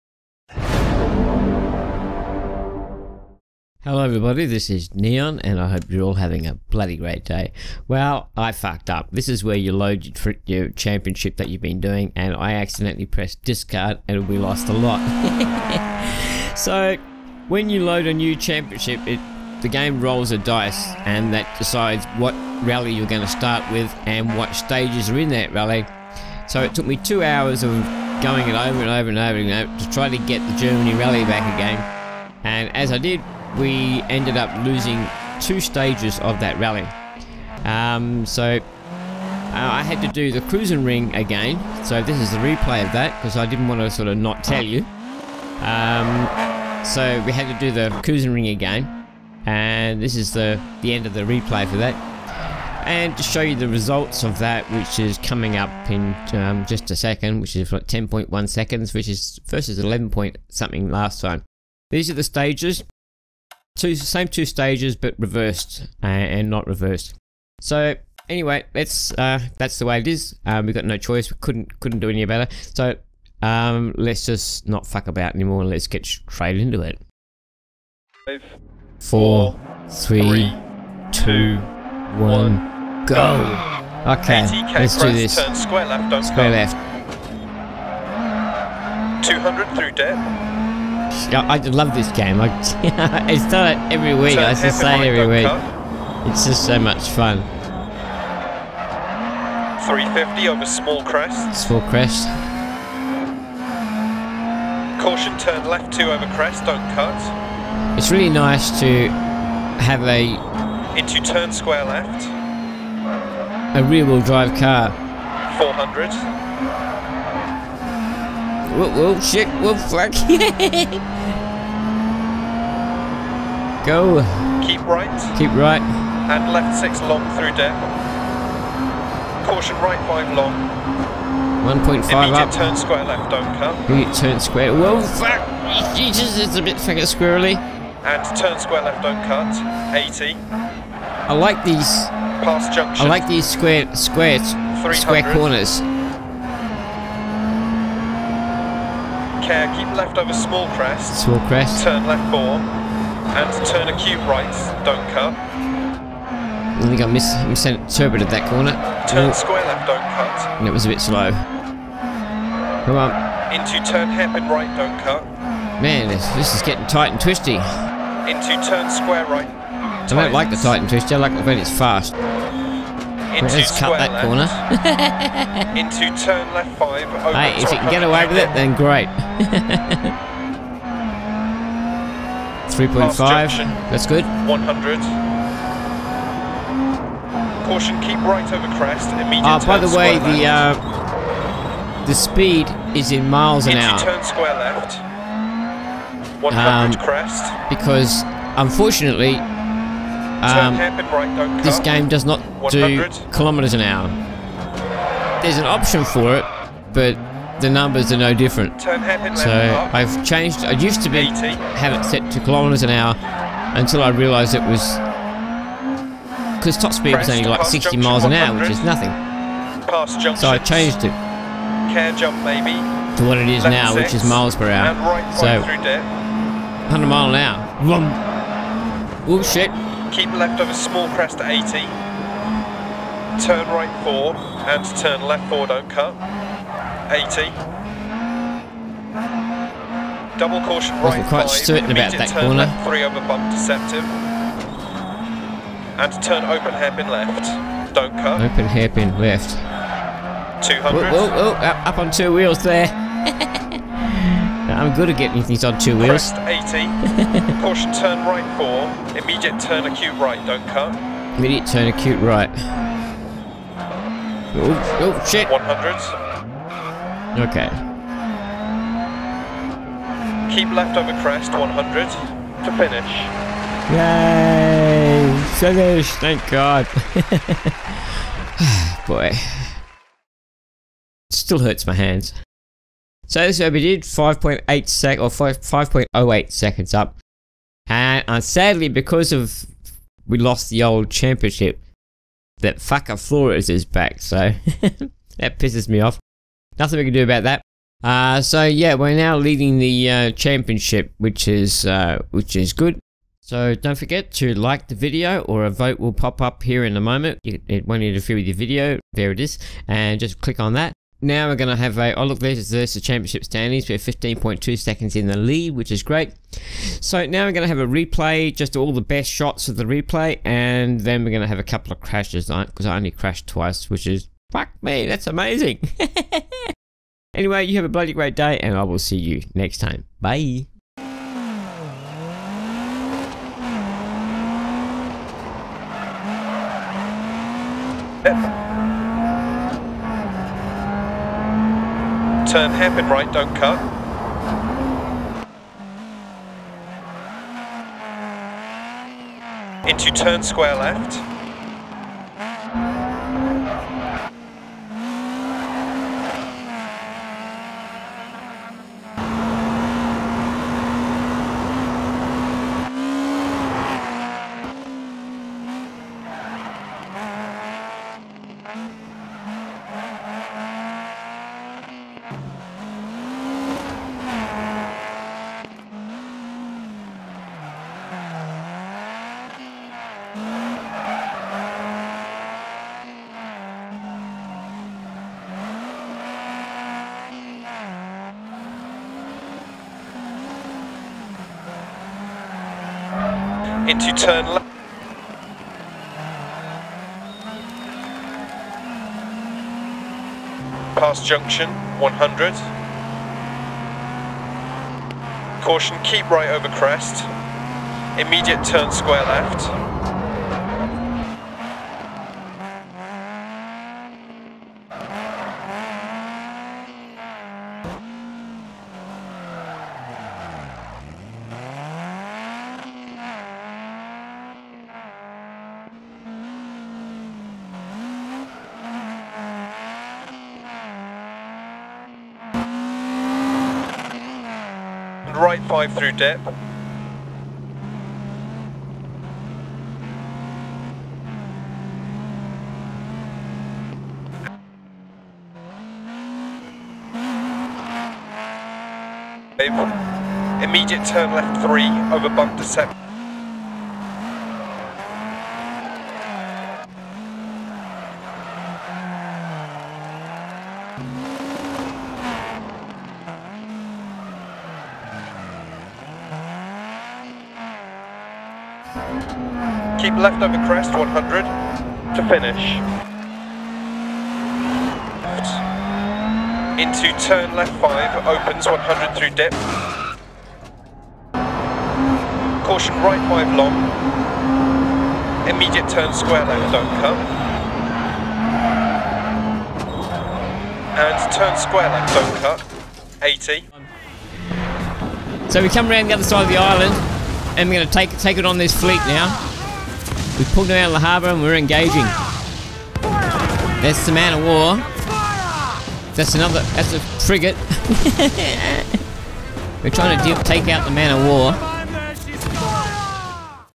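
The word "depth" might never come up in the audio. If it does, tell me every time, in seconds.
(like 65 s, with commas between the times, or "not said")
127 s, 436 s.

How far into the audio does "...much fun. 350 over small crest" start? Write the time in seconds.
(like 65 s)
96 s.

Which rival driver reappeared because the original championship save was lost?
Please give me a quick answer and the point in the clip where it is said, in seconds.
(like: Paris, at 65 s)
Flores, at 293 s.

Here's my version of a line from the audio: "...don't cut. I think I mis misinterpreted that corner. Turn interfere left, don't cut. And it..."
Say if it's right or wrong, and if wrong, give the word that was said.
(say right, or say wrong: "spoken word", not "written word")
wrong: "square", not "interfere".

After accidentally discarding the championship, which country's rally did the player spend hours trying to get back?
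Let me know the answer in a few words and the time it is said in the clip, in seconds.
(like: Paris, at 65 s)
Germany, at 30 s.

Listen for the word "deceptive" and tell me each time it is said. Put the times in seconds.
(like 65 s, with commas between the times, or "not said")
243 s.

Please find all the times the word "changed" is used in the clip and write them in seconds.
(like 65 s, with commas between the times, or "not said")
210 s, 220 s.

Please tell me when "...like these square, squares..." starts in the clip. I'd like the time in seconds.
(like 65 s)
143 s.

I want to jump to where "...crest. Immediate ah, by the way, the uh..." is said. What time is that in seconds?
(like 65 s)
188 s.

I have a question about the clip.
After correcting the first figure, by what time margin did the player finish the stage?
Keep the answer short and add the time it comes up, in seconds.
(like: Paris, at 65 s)
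5.08 seconds, at 285 s.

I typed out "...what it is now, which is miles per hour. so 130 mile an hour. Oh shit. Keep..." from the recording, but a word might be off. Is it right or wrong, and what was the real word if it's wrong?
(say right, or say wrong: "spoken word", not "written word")
wrong: "100", not "130".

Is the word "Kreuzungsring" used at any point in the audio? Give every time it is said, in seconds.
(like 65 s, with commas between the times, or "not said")
40 s, 48 s.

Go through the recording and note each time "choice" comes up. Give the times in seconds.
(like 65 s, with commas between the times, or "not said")
70 s.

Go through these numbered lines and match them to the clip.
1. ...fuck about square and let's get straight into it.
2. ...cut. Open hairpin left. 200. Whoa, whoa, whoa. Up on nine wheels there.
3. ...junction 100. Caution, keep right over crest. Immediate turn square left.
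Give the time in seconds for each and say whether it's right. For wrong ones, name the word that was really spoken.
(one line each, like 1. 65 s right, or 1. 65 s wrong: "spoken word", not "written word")
1. 74 s wrong: "anymore", not "square"
2. 248 s wrong: "two", not "nine"
3. 401 s right.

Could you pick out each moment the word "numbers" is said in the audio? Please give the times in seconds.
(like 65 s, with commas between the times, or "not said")
207 s.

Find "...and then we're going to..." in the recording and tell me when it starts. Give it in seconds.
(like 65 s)
320 s.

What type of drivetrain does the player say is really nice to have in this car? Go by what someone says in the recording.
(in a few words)
rear wheel drive.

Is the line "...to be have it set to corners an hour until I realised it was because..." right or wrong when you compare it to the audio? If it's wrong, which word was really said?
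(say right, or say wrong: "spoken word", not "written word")
wrong: "kilometers", not "corners".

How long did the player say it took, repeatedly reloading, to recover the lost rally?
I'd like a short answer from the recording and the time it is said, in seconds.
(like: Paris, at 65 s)
2 hours, at 26 s.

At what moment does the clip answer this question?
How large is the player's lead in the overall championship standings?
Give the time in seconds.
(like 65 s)
313 s.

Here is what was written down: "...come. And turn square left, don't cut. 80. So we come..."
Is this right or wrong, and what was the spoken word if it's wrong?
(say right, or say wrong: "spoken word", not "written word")
right.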